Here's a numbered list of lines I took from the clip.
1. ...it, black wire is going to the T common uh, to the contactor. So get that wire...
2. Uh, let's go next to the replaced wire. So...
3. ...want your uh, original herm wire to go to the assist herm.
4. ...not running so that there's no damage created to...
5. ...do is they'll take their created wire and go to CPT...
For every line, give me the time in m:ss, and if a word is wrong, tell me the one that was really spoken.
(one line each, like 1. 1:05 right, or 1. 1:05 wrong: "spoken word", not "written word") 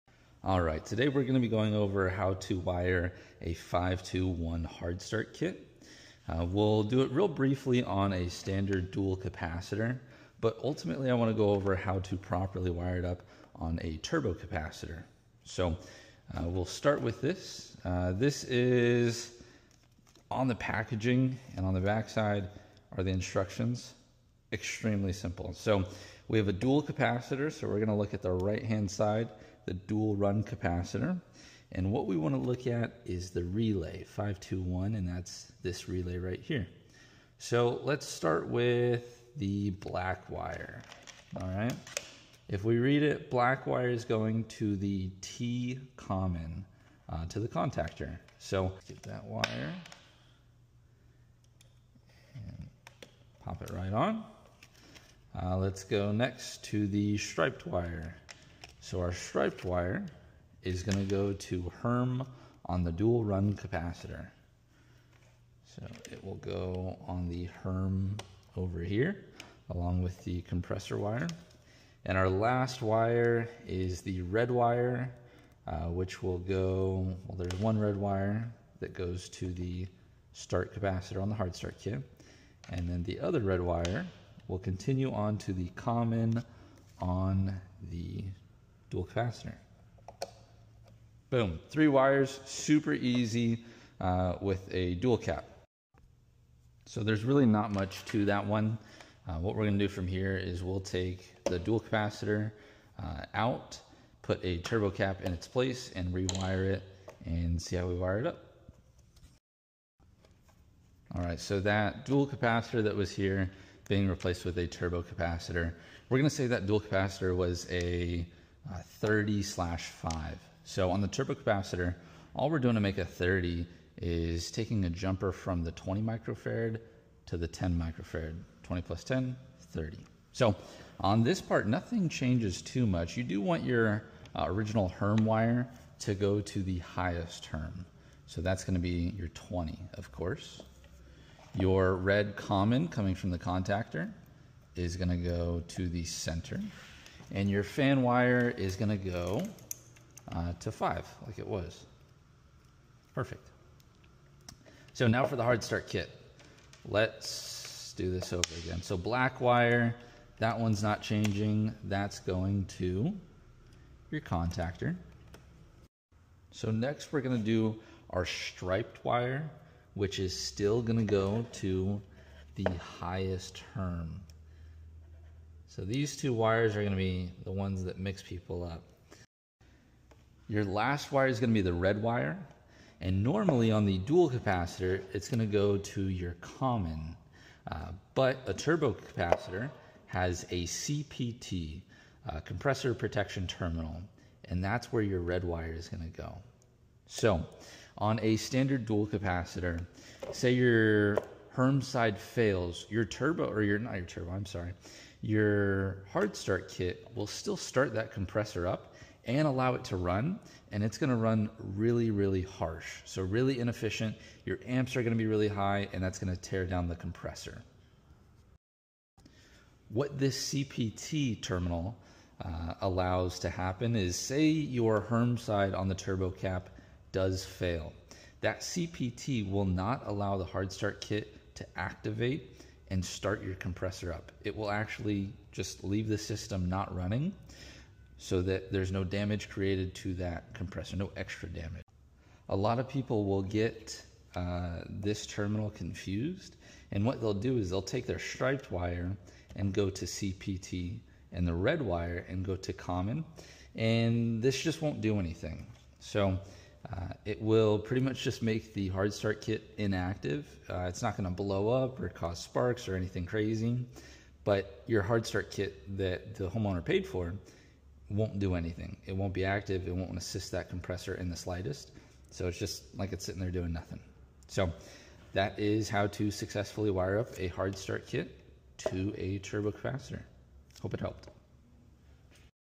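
1. 0:43 right
2. 0:55 wrong: "striped", not "replaced"
3. 2:13 wrong: "highest", not "assist"
4. 3:56 right
5. 4:07 wrong: "striped", not "created".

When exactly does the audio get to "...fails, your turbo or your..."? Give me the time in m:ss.
3:22.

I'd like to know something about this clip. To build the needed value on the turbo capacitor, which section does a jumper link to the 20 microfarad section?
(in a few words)
10 microfarad.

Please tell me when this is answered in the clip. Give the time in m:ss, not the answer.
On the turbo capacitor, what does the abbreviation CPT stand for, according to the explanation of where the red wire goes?
3:12.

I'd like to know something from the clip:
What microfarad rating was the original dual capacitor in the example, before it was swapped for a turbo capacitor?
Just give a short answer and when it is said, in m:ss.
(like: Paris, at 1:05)
30/5, at 1:58.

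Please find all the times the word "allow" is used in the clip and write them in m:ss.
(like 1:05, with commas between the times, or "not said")
3:29, 3:42, 3:50.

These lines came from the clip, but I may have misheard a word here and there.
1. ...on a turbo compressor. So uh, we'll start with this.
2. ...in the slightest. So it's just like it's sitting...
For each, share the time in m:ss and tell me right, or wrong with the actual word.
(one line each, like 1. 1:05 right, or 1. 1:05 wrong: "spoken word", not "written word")
1. 0:13 wrong: "capacitor", not "compressor"
2. 4:31 right.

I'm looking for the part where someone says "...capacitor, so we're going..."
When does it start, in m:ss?
0:26.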